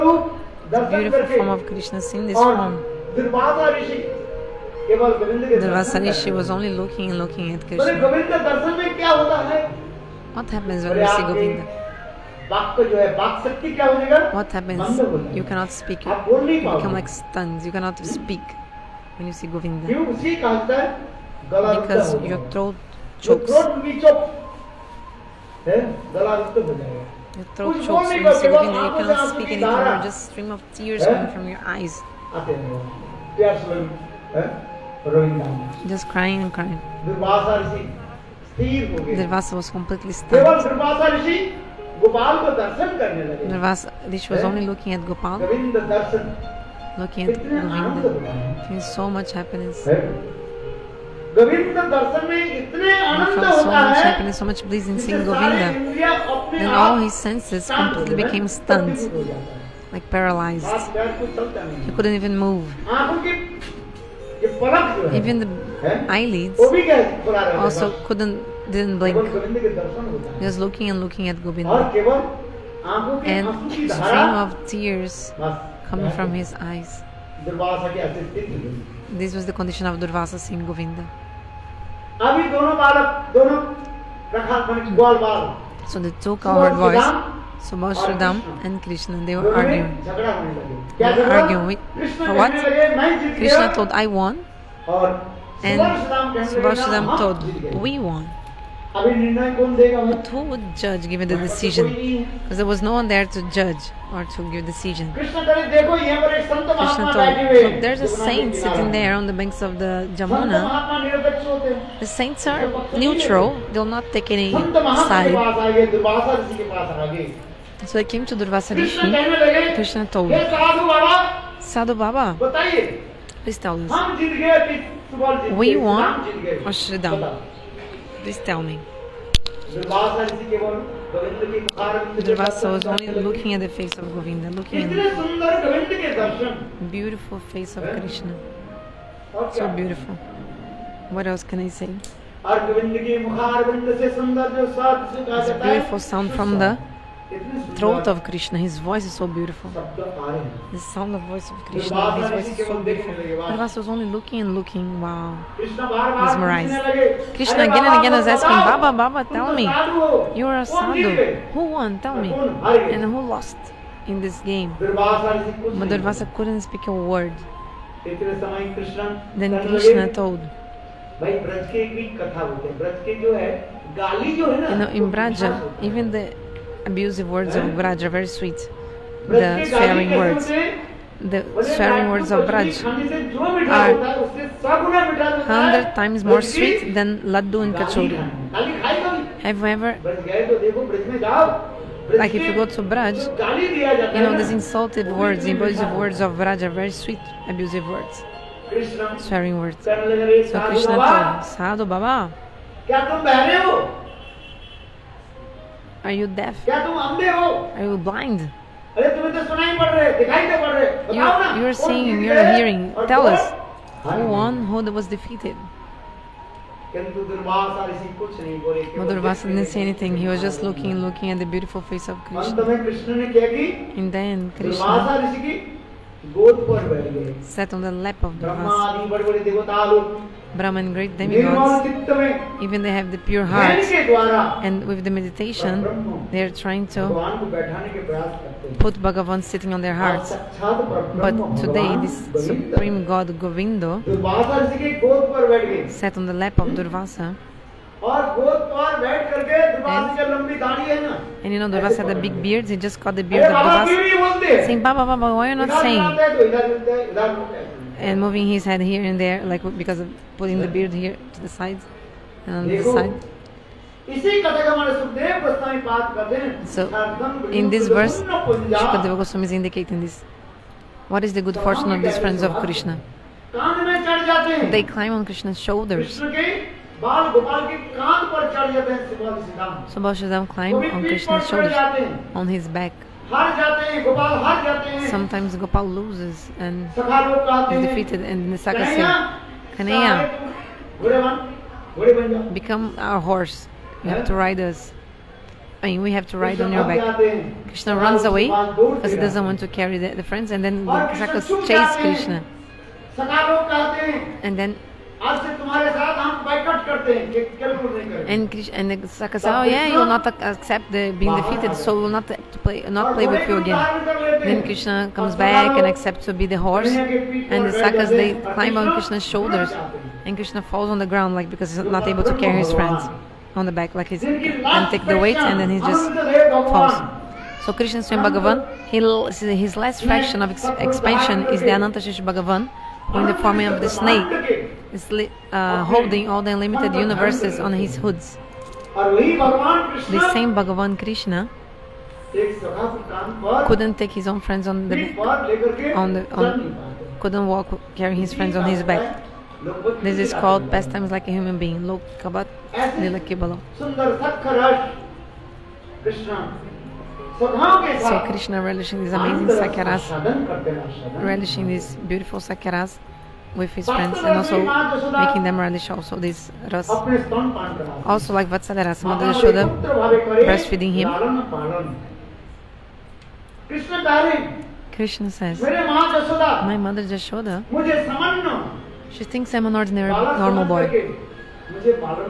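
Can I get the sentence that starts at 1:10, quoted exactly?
Just looking and looking at Govinda.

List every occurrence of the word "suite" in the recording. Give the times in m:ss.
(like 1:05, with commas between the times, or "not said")
not said.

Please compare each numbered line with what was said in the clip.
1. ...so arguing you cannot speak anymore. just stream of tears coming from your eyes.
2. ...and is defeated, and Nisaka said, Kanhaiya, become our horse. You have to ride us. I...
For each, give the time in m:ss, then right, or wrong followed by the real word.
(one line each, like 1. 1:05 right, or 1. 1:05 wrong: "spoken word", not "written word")
1. 0:28 wrong: "soothing", not "arguing"
2. 4:46 right.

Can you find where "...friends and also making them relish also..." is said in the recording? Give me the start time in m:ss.
6:03.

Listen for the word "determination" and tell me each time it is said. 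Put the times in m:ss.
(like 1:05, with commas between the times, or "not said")
not said.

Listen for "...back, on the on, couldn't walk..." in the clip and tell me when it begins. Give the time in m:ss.
5:45.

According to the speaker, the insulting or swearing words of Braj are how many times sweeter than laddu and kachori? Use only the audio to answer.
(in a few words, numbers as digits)
100.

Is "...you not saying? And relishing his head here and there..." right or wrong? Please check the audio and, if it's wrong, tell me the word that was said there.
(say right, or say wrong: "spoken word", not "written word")
wrong: "moving", not "relishing".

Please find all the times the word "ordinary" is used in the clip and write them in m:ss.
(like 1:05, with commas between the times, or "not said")
6:19.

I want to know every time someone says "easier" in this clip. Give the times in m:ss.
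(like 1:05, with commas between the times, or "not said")
not said.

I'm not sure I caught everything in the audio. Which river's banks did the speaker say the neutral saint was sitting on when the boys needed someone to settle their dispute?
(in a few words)
Jamuna.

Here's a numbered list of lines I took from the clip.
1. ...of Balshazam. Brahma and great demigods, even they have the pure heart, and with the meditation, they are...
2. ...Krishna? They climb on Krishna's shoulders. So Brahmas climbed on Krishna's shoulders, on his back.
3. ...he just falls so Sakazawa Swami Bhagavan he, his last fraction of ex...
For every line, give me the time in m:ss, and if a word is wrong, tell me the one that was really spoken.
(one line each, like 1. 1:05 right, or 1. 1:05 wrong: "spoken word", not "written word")
1. 3:48 wrong: "Brahmas", not "Balshazam"
2. 4:32 wrong: "Balshazam", not "Brahmas"
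3. 5:25 wrong: "Krishna", not "Sakazawa".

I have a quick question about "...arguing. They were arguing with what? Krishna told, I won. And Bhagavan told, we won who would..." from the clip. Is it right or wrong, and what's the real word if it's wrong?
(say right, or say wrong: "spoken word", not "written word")
wrong: "Subhashridam", not "Bhagavan".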